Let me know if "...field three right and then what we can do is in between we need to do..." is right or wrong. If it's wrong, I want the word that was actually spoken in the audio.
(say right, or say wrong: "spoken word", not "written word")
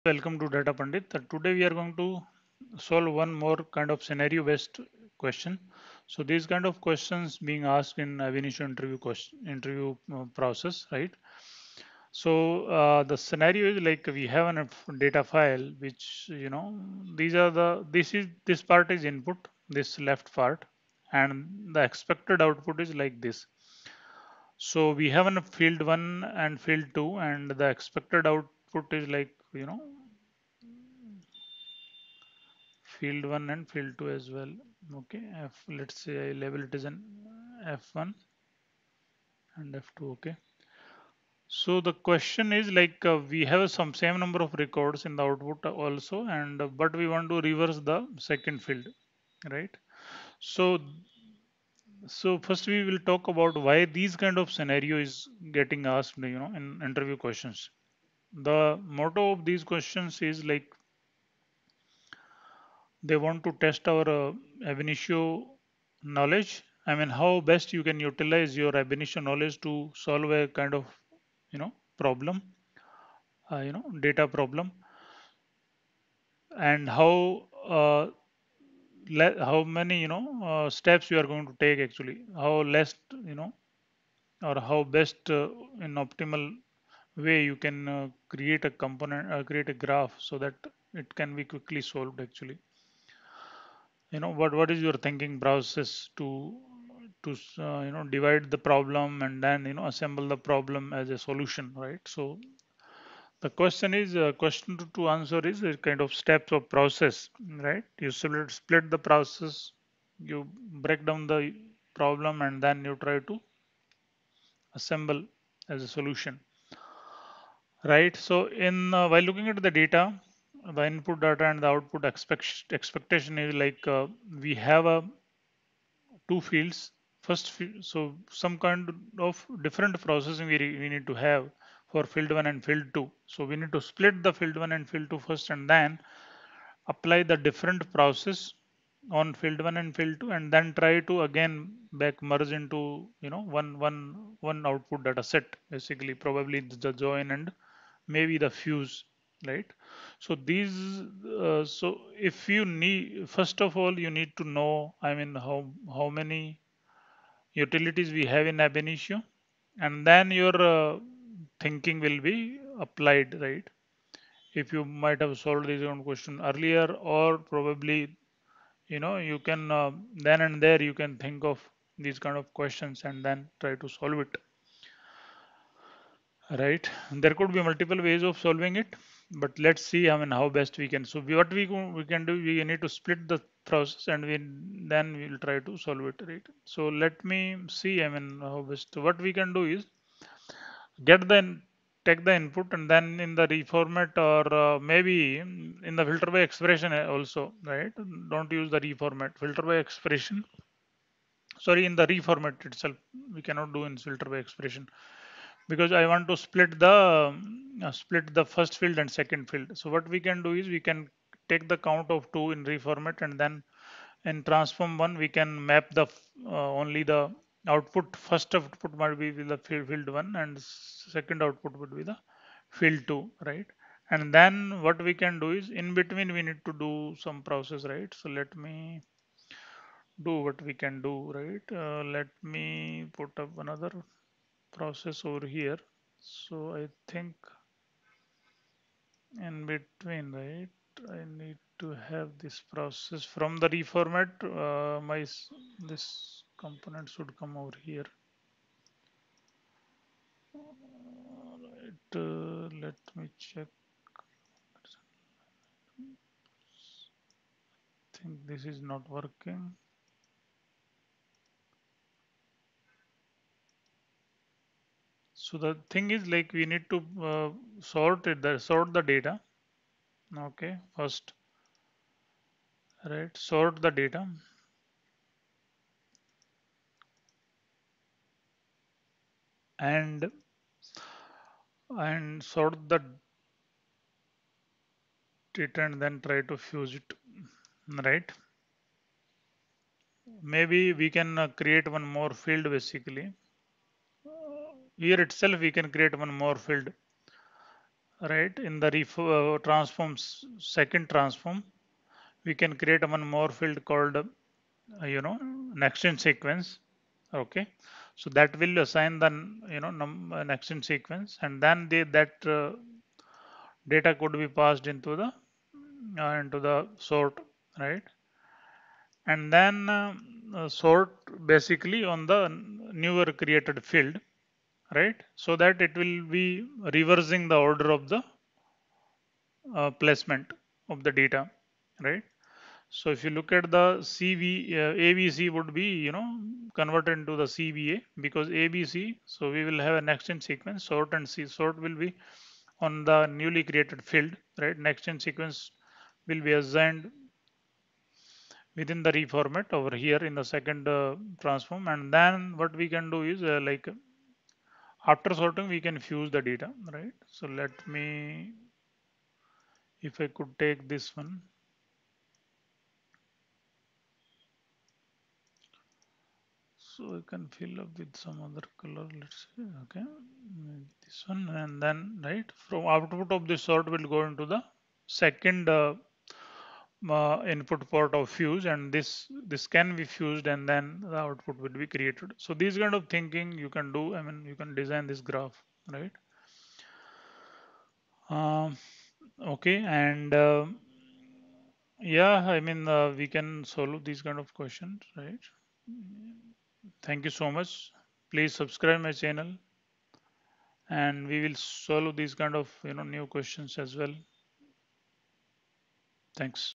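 wrong: "two", not "three".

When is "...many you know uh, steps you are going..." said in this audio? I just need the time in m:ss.
1:19.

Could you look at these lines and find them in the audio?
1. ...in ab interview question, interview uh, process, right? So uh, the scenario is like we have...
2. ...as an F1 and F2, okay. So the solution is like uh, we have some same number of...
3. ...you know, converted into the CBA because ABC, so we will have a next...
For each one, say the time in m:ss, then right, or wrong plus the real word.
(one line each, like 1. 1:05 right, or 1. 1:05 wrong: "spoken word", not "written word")
1. 0:07 right
2. 0:36 wrong: "question", not "solution"
3. 5:36 right.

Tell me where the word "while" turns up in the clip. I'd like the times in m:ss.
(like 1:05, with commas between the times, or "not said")
1:59.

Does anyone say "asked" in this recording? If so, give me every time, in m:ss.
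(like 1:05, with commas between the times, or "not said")
0:07, 0:55.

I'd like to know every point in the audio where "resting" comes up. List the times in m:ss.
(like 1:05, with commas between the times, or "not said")
not said.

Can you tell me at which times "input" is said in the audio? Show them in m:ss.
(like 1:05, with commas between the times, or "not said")
0:19, 2:00, 3:12, 6:17.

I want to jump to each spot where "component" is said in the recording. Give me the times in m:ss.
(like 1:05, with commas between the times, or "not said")
1:28, 4:06.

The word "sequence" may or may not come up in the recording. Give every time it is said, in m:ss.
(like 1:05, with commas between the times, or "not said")
5:06, 5:10, 5:40, 5:45.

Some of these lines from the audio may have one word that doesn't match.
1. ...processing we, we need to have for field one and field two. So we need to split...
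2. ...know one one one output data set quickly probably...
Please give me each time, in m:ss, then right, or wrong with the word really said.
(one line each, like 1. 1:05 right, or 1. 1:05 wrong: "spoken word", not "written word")
1. 2:10 right
2. 2:23 wrong: "basically", not "quickly".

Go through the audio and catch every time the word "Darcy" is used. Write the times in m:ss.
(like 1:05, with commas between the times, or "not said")
not said.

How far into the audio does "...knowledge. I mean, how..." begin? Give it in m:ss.
1:06.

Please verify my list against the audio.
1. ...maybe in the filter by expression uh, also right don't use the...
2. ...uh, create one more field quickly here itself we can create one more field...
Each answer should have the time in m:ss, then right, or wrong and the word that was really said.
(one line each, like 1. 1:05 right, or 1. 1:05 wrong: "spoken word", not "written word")
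1. 3:14 right
2. 4:51 wrong: "basically", not "quickly".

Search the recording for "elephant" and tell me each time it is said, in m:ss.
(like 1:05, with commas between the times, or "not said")
not said.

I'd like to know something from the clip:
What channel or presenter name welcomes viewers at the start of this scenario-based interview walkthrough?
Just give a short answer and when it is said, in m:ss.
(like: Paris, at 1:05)
DataPundit, at 0:00.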